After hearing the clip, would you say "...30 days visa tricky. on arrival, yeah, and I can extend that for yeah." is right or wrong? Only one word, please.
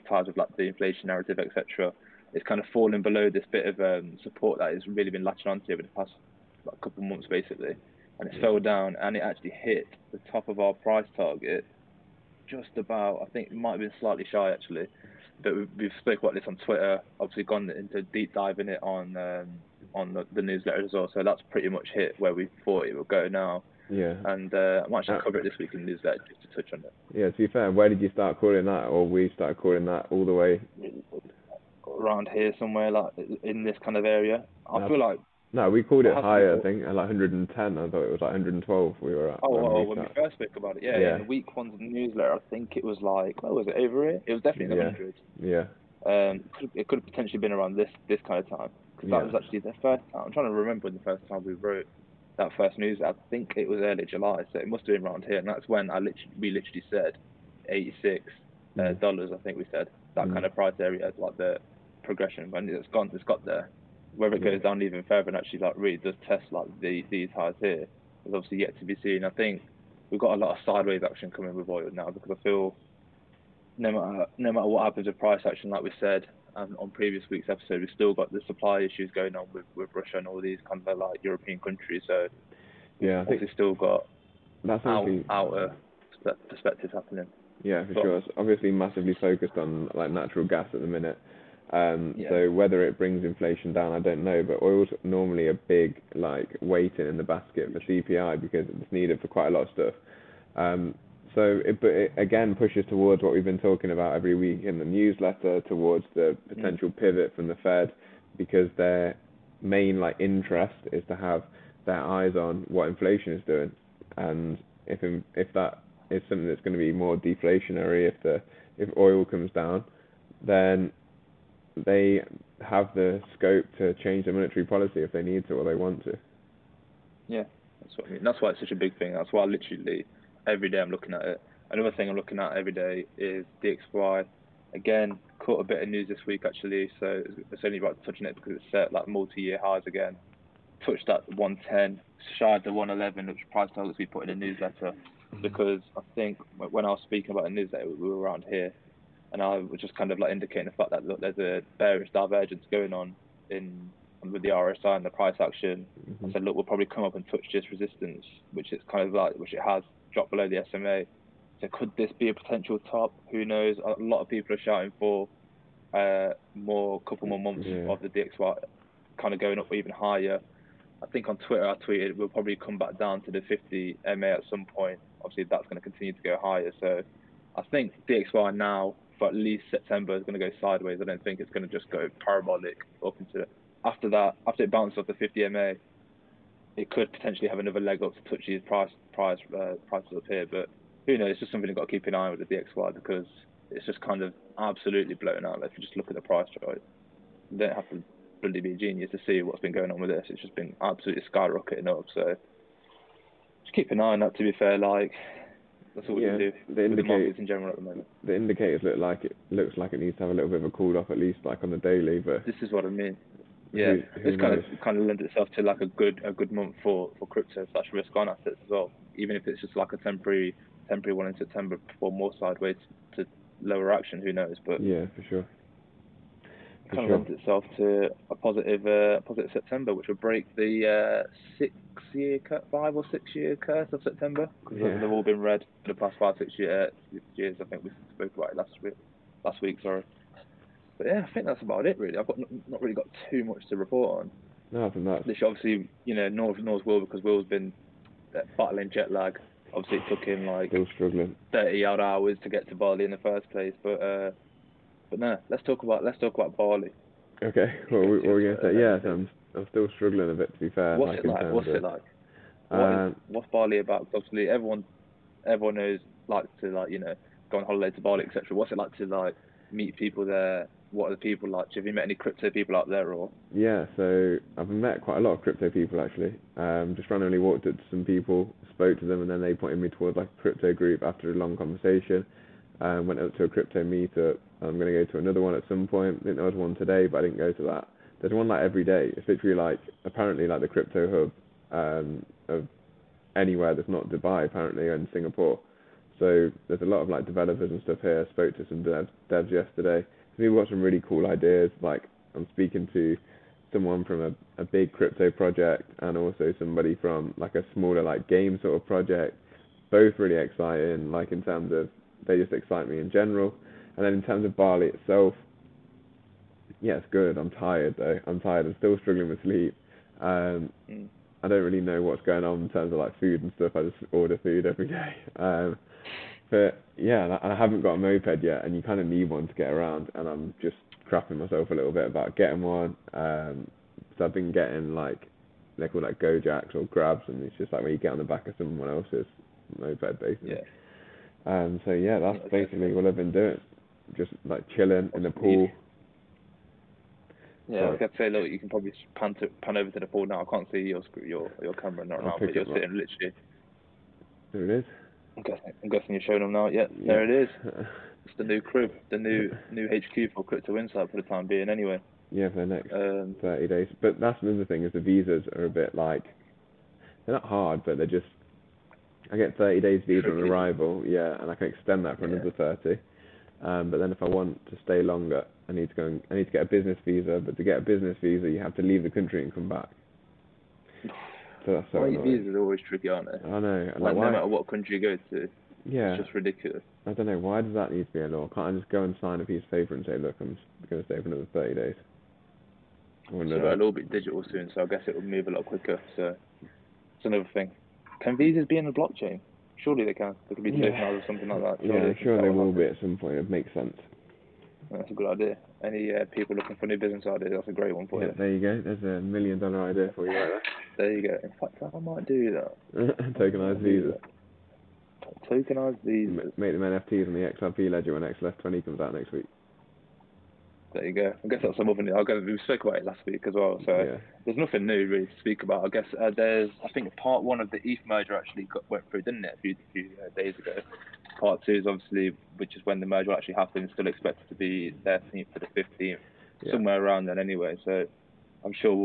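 right.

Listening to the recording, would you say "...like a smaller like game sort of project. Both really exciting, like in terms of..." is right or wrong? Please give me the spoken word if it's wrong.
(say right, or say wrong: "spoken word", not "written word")
right.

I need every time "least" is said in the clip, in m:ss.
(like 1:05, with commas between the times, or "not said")
2:59, 3:31.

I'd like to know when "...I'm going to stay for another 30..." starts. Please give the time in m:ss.
6:30.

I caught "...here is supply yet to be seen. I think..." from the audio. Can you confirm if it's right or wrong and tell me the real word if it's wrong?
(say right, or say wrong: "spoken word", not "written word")
wrong: "obviously", not "supply".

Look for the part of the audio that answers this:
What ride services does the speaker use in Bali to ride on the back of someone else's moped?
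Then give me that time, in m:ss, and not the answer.
5:36.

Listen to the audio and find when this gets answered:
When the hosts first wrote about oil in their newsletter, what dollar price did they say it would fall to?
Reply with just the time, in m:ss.
0:57.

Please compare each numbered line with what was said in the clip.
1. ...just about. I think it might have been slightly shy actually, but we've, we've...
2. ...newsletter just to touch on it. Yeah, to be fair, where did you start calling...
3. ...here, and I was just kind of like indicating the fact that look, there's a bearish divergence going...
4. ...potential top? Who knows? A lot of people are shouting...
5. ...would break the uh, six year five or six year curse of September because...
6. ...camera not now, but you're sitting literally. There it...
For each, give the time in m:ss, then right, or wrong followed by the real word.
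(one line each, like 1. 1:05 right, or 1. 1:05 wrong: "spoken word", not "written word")
1. 0:12 right
2. 0:25 right
3. 2:28 right
4. 2:42 right
5. 3:50 right
6. 5:51 right.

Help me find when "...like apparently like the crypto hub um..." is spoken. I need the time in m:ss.
4:49.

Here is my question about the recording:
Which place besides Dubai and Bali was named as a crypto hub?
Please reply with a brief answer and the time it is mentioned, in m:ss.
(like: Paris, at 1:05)
Singapore, at 4:55.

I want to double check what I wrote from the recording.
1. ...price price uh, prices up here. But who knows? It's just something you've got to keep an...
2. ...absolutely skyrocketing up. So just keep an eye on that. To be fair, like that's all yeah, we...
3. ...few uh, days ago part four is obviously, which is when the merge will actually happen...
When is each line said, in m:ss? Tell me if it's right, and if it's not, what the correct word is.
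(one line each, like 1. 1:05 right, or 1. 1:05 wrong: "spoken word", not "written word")
1. 3:08 right
2. 3:20 right
3. 7:09 wrong: "two", not "four".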